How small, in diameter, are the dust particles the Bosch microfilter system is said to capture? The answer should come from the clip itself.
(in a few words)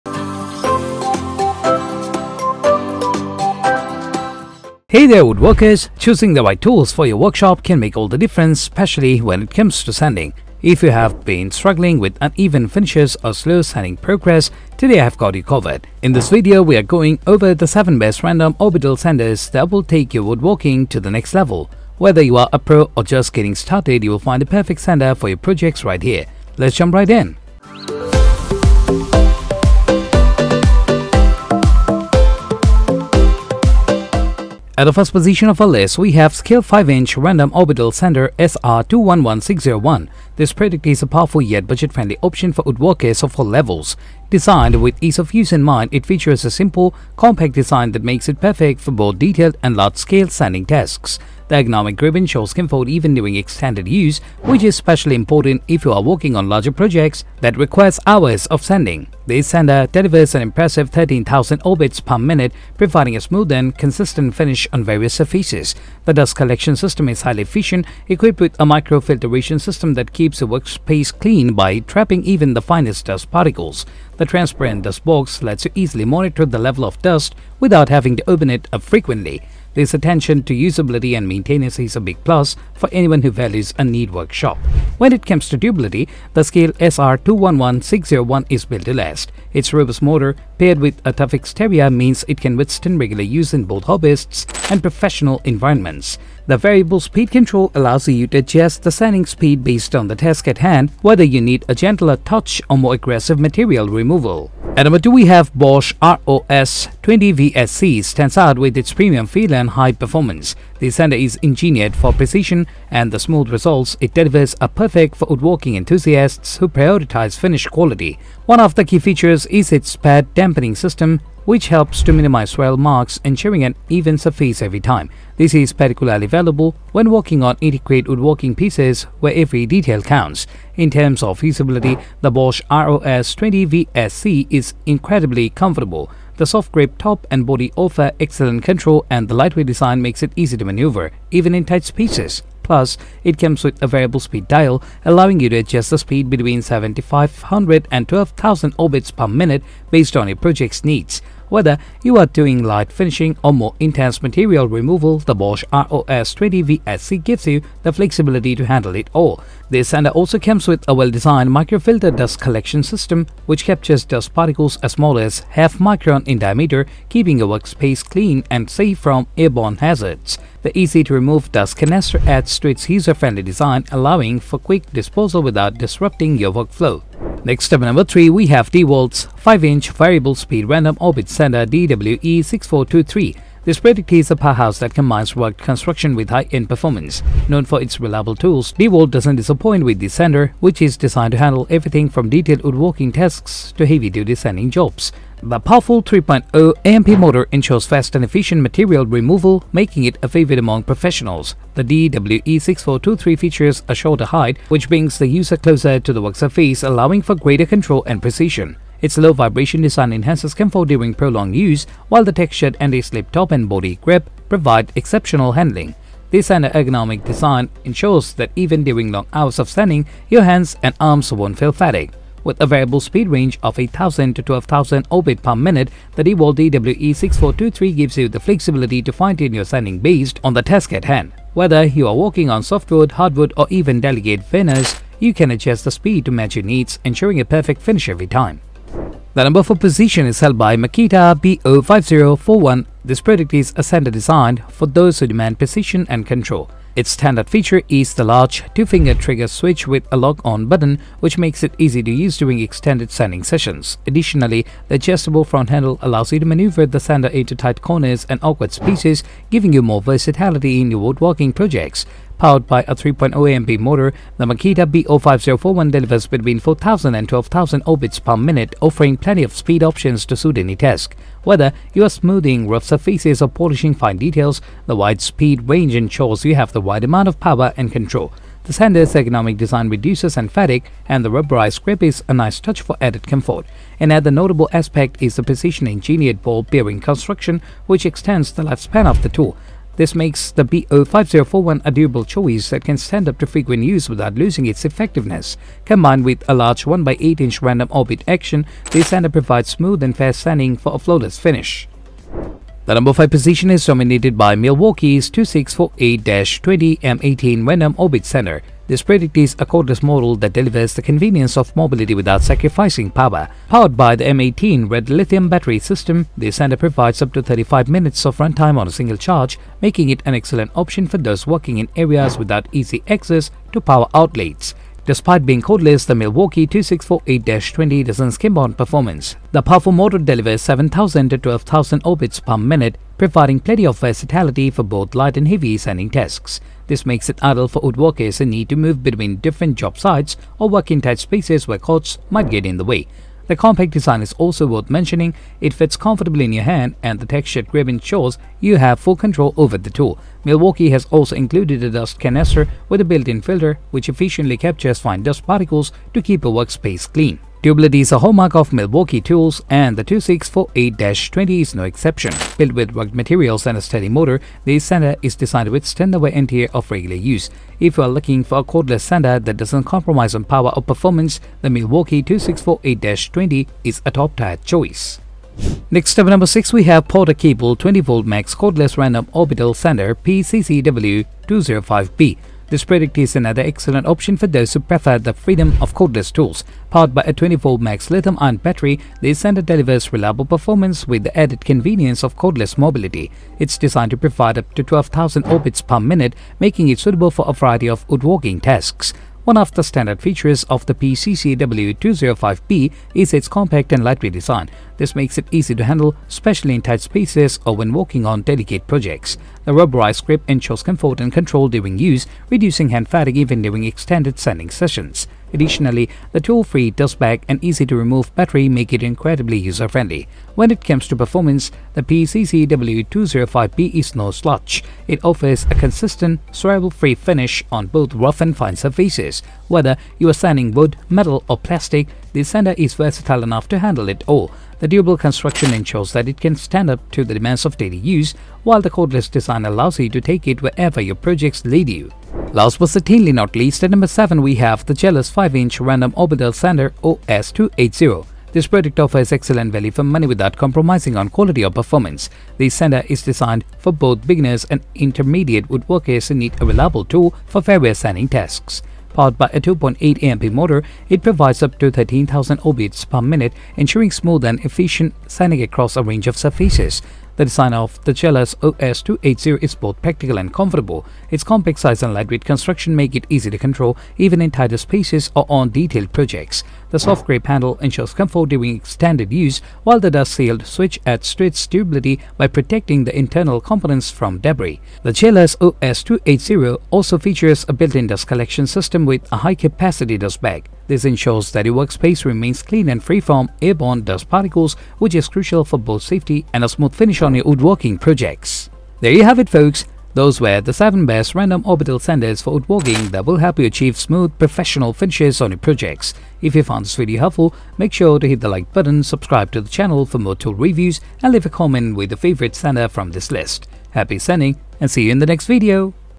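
half micron.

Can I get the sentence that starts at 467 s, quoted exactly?
The design of the Jellas OS280 is both practical and comfortable.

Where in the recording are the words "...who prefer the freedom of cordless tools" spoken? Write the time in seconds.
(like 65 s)
384 s.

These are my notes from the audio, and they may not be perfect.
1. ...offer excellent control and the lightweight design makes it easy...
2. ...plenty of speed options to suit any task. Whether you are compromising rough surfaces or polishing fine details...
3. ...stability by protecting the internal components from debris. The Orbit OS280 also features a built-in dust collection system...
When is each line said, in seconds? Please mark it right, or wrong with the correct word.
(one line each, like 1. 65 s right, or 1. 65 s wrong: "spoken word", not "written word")
1. 137 s right
2. 269 s wrong: "smoothing", not "compromising"
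3. 481 s wrong: "Jellas", not "Orbit".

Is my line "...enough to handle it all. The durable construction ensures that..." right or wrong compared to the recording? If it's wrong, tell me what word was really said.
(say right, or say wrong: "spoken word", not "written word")
right.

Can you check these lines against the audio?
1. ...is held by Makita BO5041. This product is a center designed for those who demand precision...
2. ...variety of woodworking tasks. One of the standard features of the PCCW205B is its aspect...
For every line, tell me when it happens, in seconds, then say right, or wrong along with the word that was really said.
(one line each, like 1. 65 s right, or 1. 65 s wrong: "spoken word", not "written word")
1. 240 s right
2. 397 s wrong: "compact", not "aspect".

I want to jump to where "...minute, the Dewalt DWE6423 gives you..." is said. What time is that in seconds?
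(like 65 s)
225 s.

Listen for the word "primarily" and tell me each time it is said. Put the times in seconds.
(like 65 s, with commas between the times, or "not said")
not said.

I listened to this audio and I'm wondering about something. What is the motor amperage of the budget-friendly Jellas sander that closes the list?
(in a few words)
2.8 amp.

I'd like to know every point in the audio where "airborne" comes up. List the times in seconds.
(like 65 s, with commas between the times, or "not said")
169 s, 493 s.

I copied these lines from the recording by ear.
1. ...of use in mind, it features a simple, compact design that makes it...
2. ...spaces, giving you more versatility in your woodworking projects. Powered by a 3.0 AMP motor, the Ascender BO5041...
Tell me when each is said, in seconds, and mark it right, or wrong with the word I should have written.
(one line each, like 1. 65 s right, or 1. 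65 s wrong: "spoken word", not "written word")
1. 45 s right
2. 258 s wrong: "Makita", not "Ascender".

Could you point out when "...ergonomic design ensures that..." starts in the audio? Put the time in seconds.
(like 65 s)
216 s.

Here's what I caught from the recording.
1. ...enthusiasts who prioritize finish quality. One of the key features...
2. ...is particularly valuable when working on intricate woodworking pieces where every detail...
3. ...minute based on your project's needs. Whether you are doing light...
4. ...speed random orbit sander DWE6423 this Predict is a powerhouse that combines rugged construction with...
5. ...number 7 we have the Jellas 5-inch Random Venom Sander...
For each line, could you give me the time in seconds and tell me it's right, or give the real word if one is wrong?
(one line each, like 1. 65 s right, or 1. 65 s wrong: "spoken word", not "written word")
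1. 115 s right
2. 125 s right
3. 149 s right
4. 180 s right
5. 443 s wrong: "Orbital", not "Venom".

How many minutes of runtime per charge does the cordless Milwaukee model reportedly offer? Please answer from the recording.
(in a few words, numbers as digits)
35 minutes.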